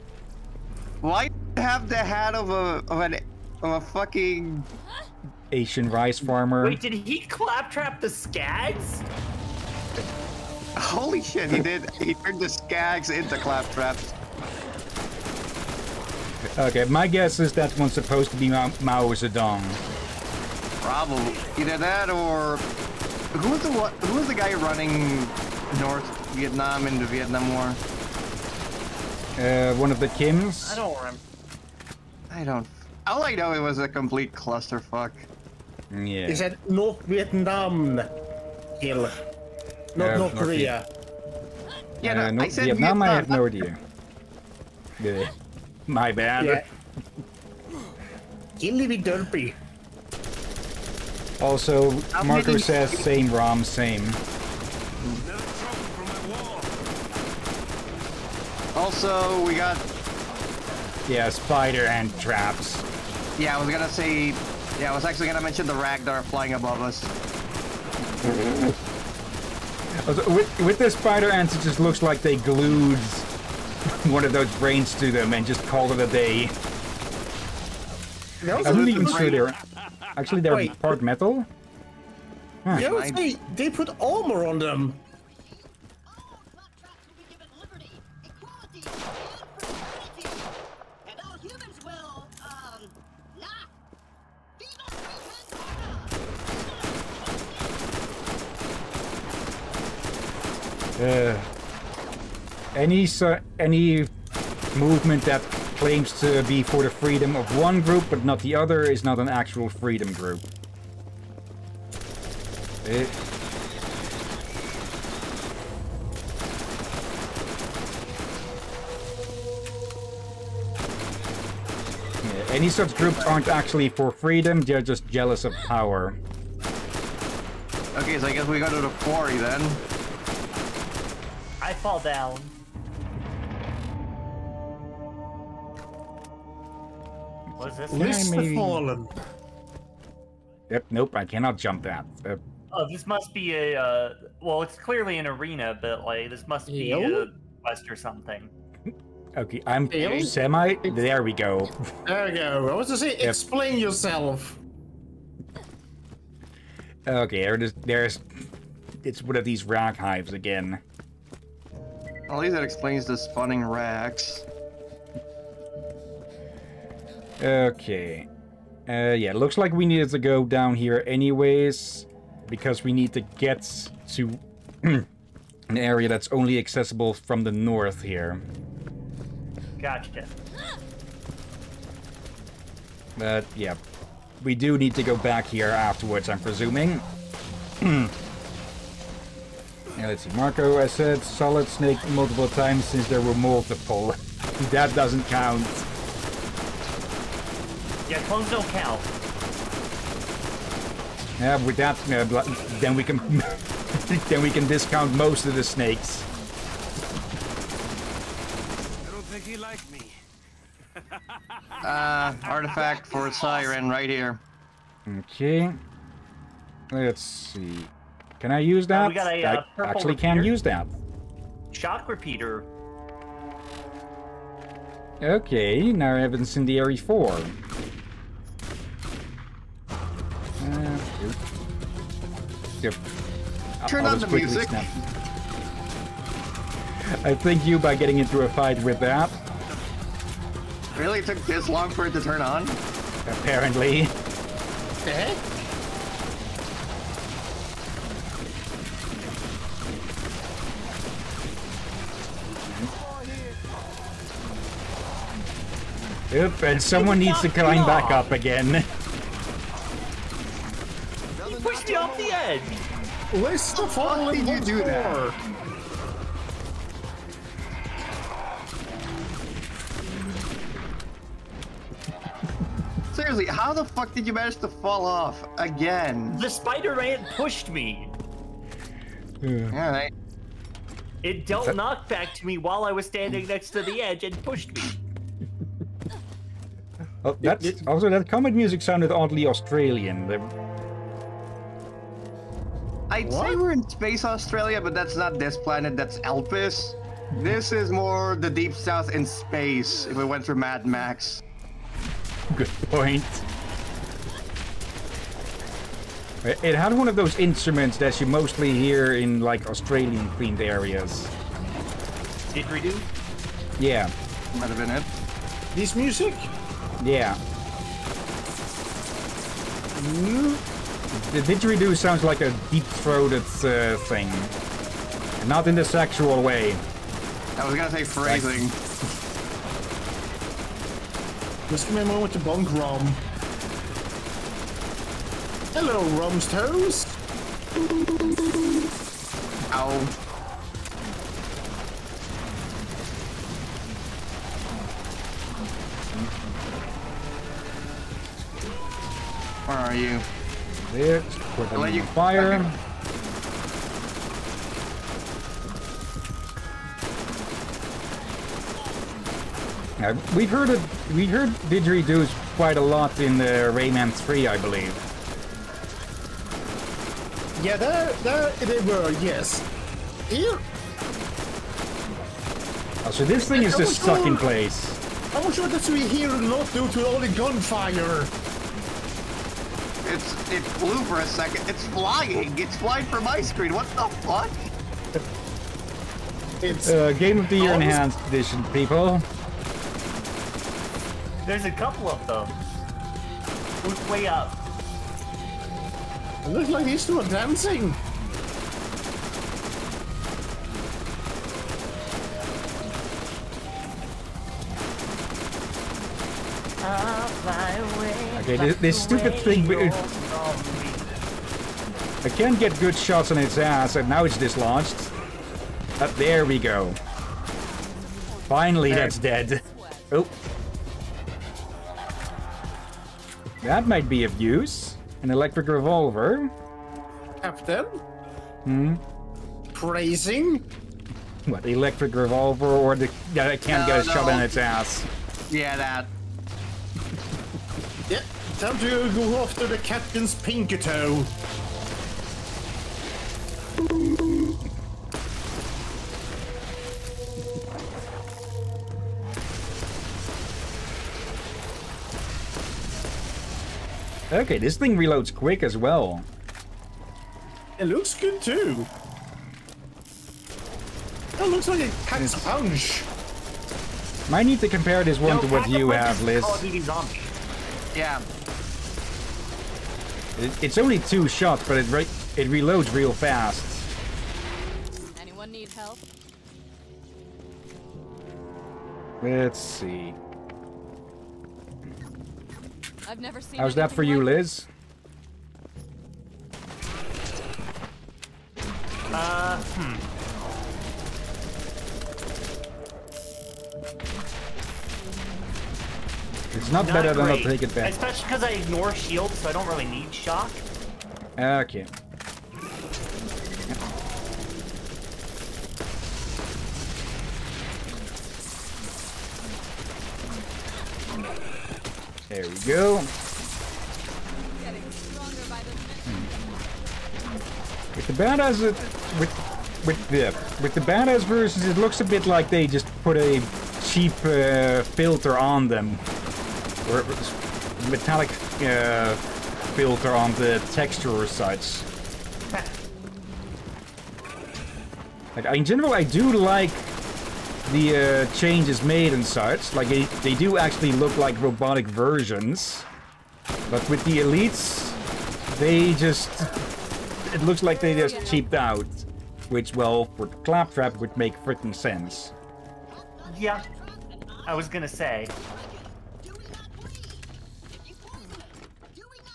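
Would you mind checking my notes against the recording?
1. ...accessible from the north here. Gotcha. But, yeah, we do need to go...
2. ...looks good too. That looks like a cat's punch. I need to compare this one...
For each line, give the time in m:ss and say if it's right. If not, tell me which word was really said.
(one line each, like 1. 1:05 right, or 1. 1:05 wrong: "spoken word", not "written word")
1. 2:56 right
2. 7:37 right.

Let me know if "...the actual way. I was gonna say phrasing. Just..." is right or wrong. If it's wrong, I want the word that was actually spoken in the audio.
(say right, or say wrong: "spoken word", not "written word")
wrong: "sexual", not "actual".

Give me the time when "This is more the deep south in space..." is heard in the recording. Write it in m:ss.
4:57.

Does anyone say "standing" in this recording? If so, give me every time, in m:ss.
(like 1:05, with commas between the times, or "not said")
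4:43.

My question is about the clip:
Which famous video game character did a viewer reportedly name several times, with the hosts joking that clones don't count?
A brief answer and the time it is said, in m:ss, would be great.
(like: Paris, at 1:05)
Solid Snake, at 3:11.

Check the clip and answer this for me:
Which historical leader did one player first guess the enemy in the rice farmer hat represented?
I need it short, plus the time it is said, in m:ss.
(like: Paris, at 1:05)
Mao Zedong, at 0:18.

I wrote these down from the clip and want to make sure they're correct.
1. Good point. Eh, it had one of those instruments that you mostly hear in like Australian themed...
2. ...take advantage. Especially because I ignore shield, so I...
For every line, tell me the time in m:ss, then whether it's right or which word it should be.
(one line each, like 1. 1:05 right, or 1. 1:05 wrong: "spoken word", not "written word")
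1. 5:02 right
2. 8:17 right.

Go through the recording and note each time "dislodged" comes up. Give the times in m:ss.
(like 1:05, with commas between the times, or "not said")
6:54.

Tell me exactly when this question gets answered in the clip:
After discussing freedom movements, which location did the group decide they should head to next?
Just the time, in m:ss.
2:08.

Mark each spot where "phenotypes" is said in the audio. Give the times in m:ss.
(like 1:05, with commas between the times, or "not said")
not said.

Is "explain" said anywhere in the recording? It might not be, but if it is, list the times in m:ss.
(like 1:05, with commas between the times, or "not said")
2:33, 2:42.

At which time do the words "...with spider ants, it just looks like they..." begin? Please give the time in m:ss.
1:10.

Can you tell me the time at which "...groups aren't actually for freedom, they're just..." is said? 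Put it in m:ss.
2:02.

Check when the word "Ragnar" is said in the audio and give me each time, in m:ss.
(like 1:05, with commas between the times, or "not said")
1:05.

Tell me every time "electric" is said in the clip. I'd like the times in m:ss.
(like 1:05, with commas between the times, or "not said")
7:05, 7:11.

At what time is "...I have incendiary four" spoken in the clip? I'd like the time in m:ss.
3:46.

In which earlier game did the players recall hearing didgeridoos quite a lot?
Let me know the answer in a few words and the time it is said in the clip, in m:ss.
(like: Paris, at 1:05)
Rayman 3, at 6:03.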